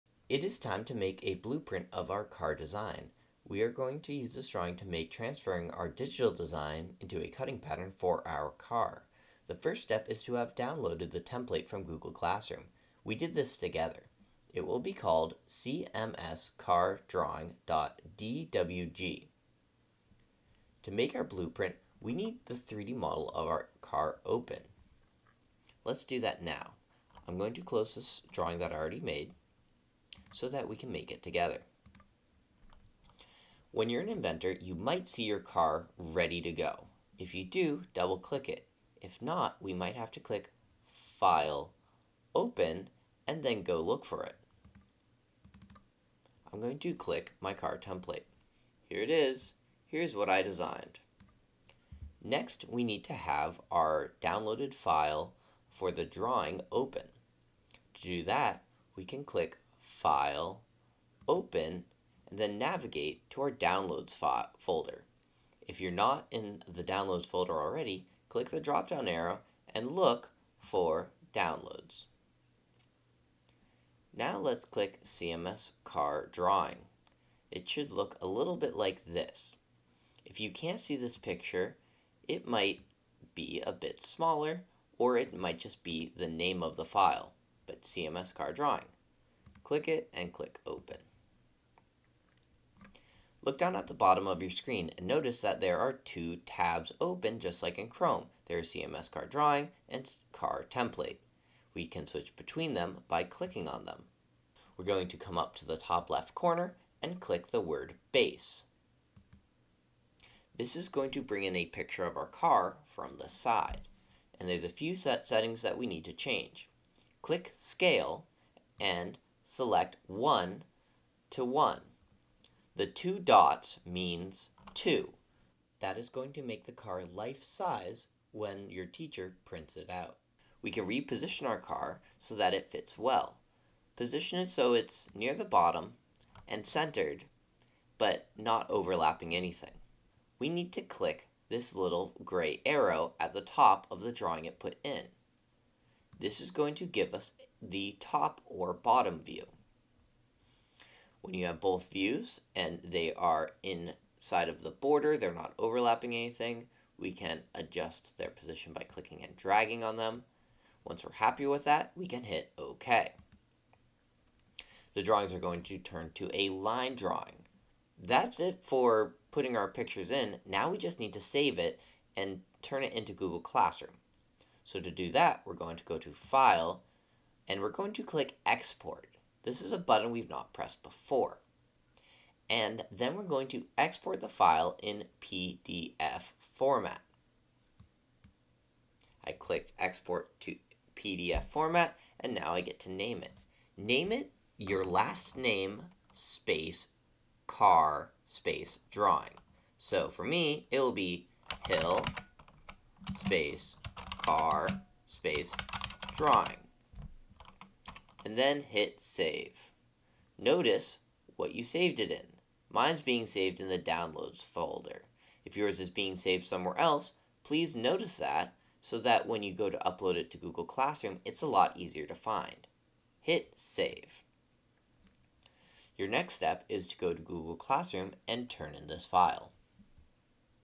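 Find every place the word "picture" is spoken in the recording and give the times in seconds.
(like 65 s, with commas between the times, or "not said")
81 s, 111 s, 169 s.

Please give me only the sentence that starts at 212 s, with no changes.
Mine's being saved in the downloads folder.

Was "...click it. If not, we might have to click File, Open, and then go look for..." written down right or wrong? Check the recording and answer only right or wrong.
right.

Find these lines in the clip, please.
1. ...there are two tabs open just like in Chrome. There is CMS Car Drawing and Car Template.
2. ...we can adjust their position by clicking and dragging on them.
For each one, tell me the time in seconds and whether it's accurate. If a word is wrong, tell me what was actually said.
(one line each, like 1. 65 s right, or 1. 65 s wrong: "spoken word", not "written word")
1. 95 s right
2. 156 s right.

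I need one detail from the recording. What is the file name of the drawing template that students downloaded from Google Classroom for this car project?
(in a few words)
cmscardrawing.dwg.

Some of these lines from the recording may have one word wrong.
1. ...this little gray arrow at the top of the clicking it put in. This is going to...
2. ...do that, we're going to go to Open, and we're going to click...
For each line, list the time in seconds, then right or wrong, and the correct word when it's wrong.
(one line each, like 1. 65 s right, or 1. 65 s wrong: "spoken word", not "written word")
1. 141 s wrong: "drawing", not "clicking"
2. 174 s wrong: "File", not "Open".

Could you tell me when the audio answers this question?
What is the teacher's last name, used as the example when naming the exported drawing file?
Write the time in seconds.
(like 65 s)
201 s.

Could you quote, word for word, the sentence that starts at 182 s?
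And then we're going to export the file in PDF format.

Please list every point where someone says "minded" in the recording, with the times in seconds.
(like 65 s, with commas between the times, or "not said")
not said.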